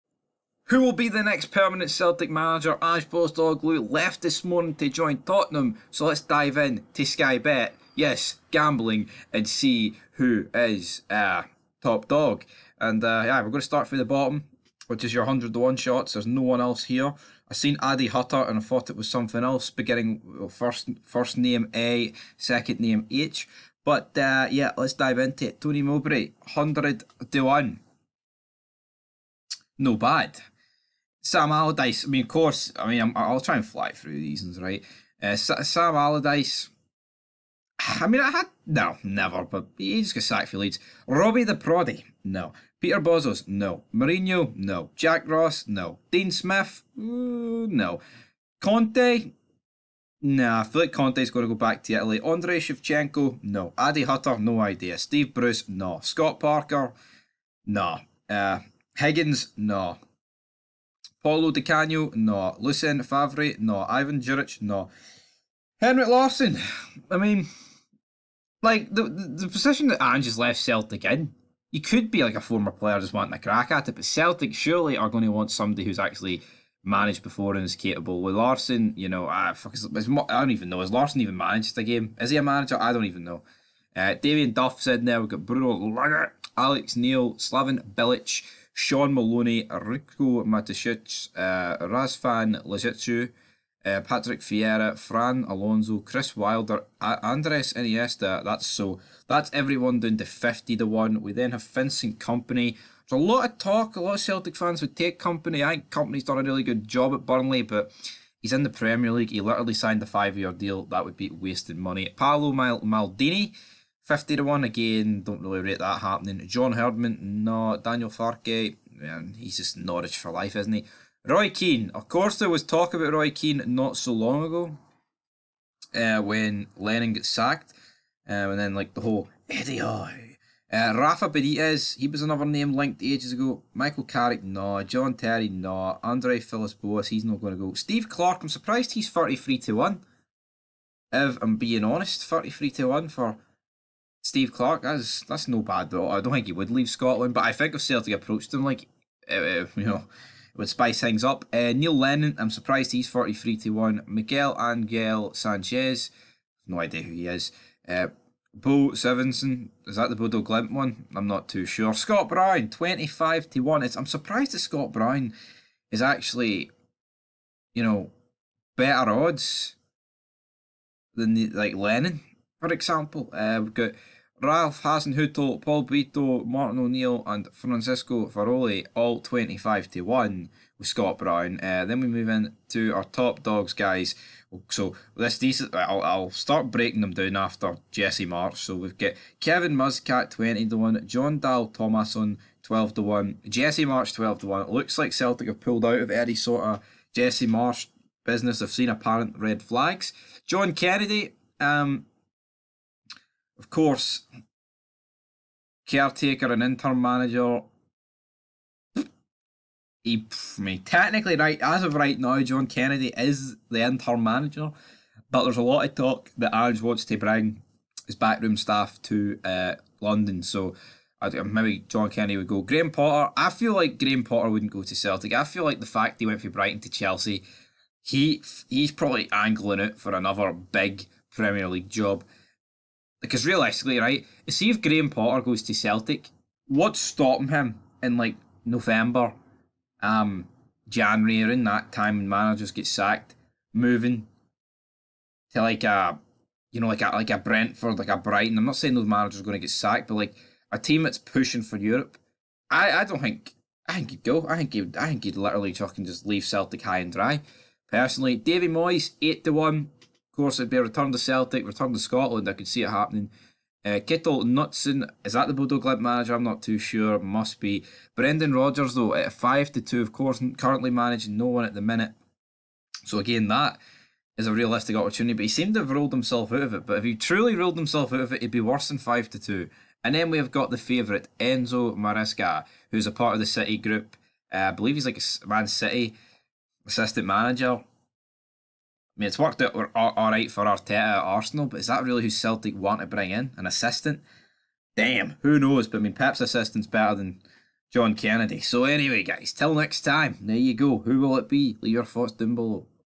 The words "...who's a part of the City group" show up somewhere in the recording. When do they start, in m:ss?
4:42.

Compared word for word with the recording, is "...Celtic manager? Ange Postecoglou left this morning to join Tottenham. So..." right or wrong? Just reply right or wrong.
right.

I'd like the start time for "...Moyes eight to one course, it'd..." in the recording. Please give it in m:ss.
4:18.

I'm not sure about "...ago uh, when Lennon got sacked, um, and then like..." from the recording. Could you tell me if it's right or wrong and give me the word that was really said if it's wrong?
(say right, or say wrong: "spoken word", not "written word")
right.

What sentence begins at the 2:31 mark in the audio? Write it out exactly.
Uh, Neil Lennon, I'm surprised he's 43 to one.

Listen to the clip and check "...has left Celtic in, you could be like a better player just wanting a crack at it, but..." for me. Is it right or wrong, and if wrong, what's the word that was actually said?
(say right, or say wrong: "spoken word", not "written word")
wrong: "former", not "better".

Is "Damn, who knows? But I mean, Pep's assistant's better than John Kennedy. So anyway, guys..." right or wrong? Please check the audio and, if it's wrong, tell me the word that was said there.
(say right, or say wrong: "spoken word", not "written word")
right.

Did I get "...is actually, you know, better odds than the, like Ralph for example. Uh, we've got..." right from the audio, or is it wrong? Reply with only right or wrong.
wrong.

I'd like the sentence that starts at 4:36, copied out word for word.
But if he truly ruled himself out of it, he'd be worse than 5 to 2.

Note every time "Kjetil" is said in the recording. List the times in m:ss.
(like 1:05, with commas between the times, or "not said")
4:23.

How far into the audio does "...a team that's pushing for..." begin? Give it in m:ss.
4:10.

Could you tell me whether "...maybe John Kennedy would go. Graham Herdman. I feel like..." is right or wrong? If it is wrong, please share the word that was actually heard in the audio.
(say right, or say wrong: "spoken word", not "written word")
wrong: "Potter", not "Herdman".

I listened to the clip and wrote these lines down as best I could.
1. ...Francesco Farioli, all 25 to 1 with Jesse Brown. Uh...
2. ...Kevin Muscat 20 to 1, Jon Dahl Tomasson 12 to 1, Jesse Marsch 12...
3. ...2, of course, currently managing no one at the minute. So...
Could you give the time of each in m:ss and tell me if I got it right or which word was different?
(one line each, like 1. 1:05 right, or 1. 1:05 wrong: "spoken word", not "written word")
1. 2:57 wrong: "Scott", not "Jesse"
2. 3:09 right
3. 4:29 right.